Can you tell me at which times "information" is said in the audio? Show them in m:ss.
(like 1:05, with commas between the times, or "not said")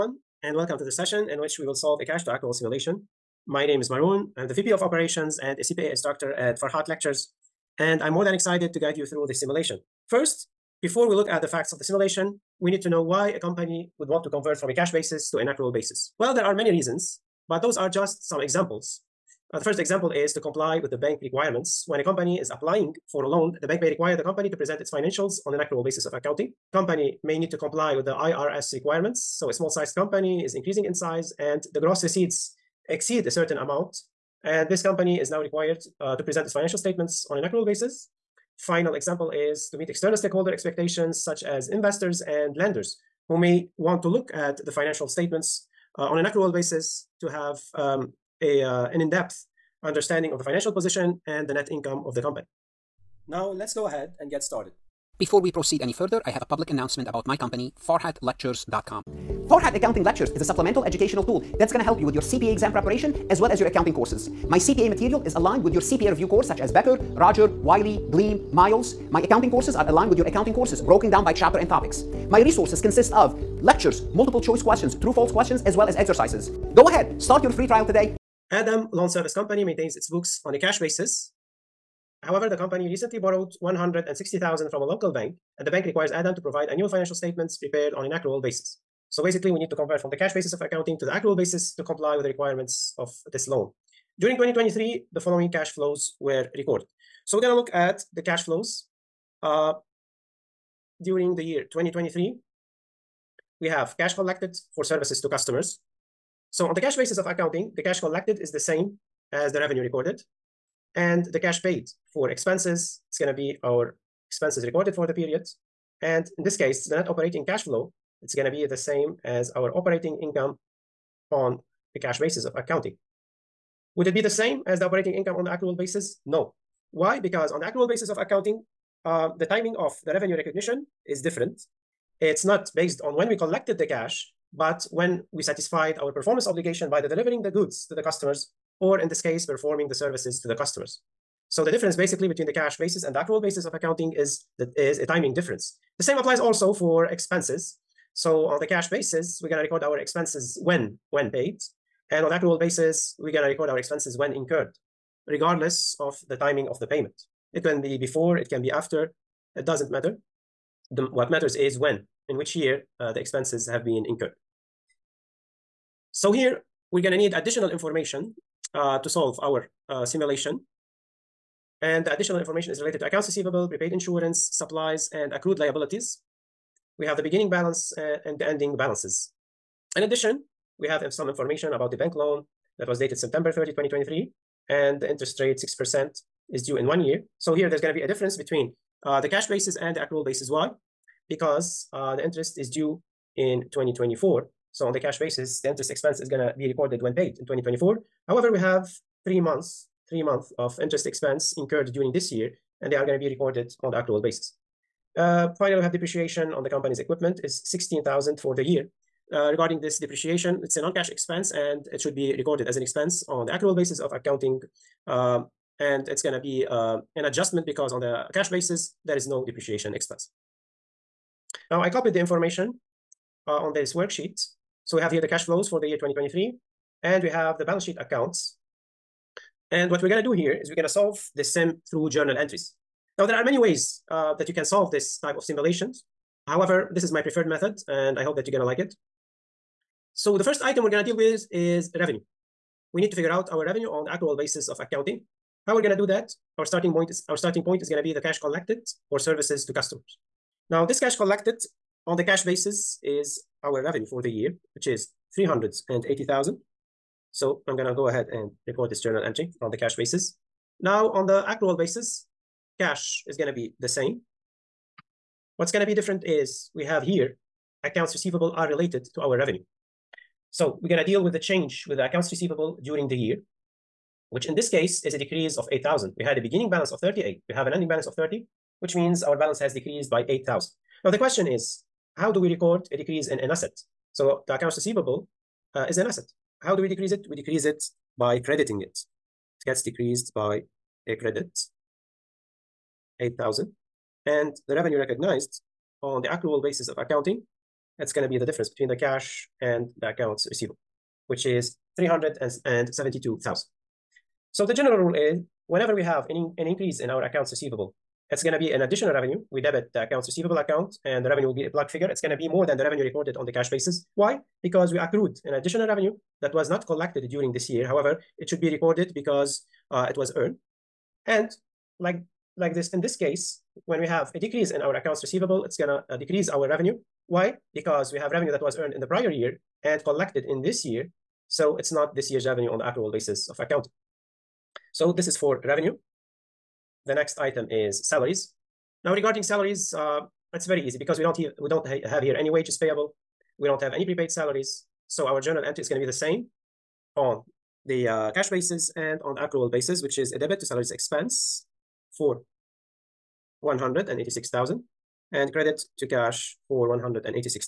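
2:47, 2:52, 3:01, 3:42.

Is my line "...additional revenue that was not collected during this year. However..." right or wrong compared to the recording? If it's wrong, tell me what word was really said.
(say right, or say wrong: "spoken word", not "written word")
right.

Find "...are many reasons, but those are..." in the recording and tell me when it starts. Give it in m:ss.
0:16.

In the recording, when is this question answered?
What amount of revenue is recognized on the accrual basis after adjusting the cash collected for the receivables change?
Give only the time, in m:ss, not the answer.
5:01.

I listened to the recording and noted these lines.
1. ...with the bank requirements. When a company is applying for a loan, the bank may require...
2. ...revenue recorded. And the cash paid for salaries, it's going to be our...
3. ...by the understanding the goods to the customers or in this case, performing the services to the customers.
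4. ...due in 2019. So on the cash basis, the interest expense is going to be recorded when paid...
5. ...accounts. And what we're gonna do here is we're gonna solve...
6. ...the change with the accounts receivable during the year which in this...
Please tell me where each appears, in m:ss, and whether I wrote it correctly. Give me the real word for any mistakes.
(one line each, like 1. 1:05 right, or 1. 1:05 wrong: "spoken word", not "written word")
1. 0:20 right
2. 1:49 wrong: "expenses", not "salaries"
3. 2:16 wrong: "delivering", not "understanding"
4. 3:12 wrong: "2024", not "2019"
5. 3:47 right
6. 4:31 right.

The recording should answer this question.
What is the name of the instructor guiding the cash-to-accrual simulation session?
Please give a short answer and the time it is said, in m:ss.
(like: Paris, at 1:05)
Maroon, at 0:03.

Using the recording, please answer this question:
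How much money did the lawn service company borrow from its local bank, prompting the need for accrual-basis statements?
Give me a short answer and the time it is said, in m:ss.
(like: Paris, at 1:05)
160,000, at 1:23.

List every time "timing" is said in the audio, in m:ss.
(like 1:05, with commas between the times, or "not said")
2:09, 2:25, 2:36.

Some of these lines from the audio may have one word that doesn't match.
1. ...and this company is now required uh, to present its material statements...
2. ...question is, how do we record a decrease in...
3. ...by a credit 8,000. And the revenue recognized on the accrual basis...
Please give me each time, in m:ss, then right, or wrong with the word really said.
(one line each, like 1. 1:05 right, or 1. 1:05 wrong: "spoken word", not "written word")
1. 0:34 wrong: "financial", not "material"
2. 4:41 right
3. 4:50 right.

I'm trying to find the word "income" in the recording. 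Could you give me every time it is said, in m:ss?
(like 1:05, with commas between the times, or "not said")
0:51, 2:00, 2:05.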